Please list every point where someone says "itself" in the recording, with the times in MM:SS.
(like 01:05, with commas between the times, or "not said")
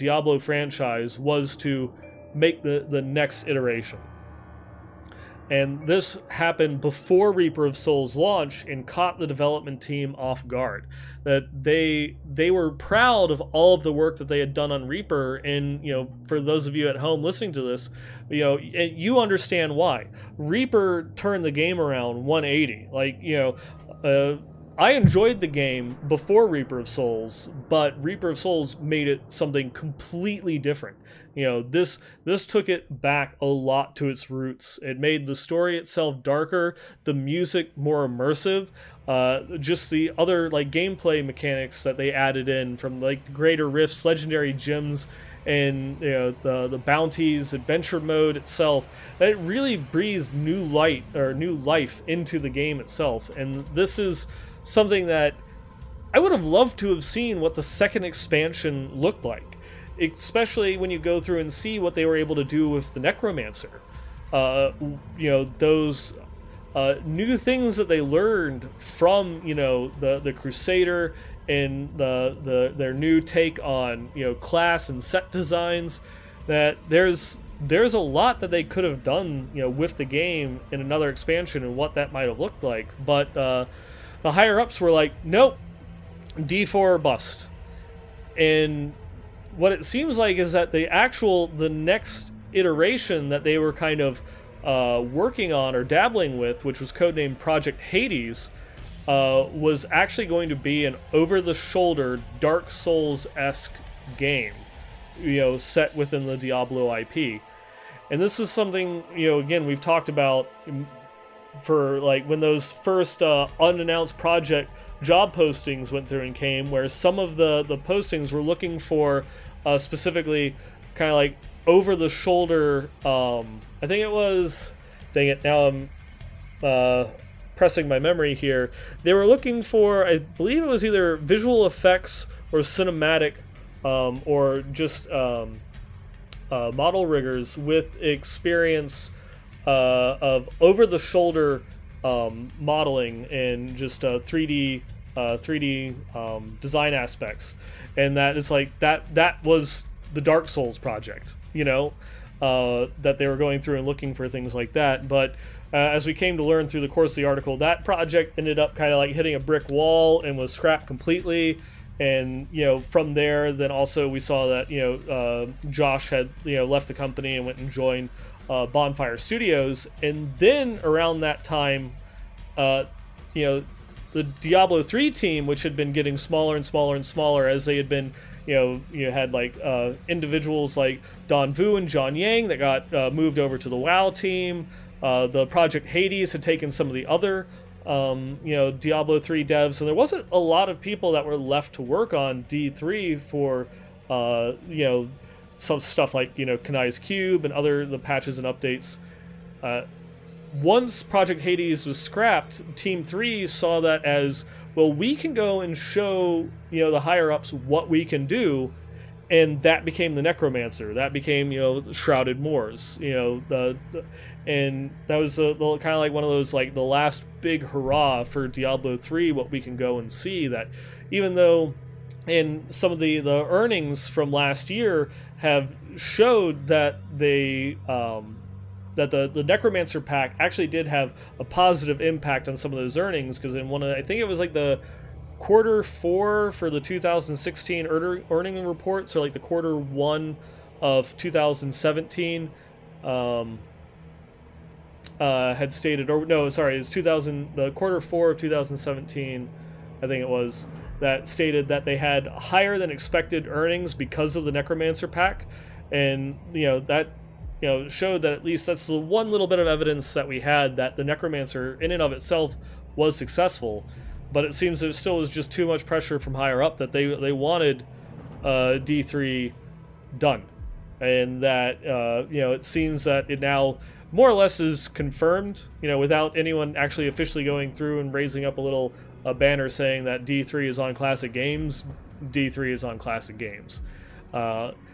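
00:35, 00:48, 00:52, 04:22.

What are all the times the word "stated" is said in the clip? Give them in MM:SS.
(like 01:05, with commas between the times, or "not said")
04:05, 04:11.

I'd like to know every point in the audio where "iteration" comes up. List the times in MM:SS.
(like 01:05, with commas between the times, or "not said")
00:03, 01:32.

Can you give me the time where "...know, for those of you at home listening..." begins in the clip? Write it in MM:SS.
00:15.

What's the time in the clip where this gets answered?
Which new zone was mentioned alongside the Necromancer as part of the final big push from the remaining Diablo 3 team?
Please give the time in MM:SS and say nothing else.
03:31.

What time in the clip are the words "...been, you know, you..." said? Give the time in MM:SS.
02:57.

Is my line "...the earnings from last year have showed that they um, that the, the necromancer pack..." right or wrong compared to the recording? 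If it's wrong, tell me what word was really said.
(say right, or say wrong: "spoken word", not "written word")
right.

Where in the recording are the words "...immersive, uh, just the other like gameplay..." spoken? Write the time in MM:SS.
00:38.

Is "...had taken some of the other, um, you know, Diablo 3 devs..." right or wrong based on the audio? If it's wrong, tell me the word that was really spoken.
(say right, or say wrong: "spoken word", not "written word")
right.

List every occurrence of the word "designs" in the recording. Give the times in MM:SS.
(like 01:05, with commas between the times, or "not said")
01:15, 02:26.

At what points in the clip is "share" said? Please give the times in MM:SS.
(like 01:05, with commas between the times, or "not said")
not said.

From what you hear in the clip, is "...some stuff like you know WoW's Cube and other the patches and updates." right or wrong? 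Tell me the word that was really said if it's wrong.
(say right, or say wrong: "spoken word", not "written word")
wrong: "Kanai", not "WoW".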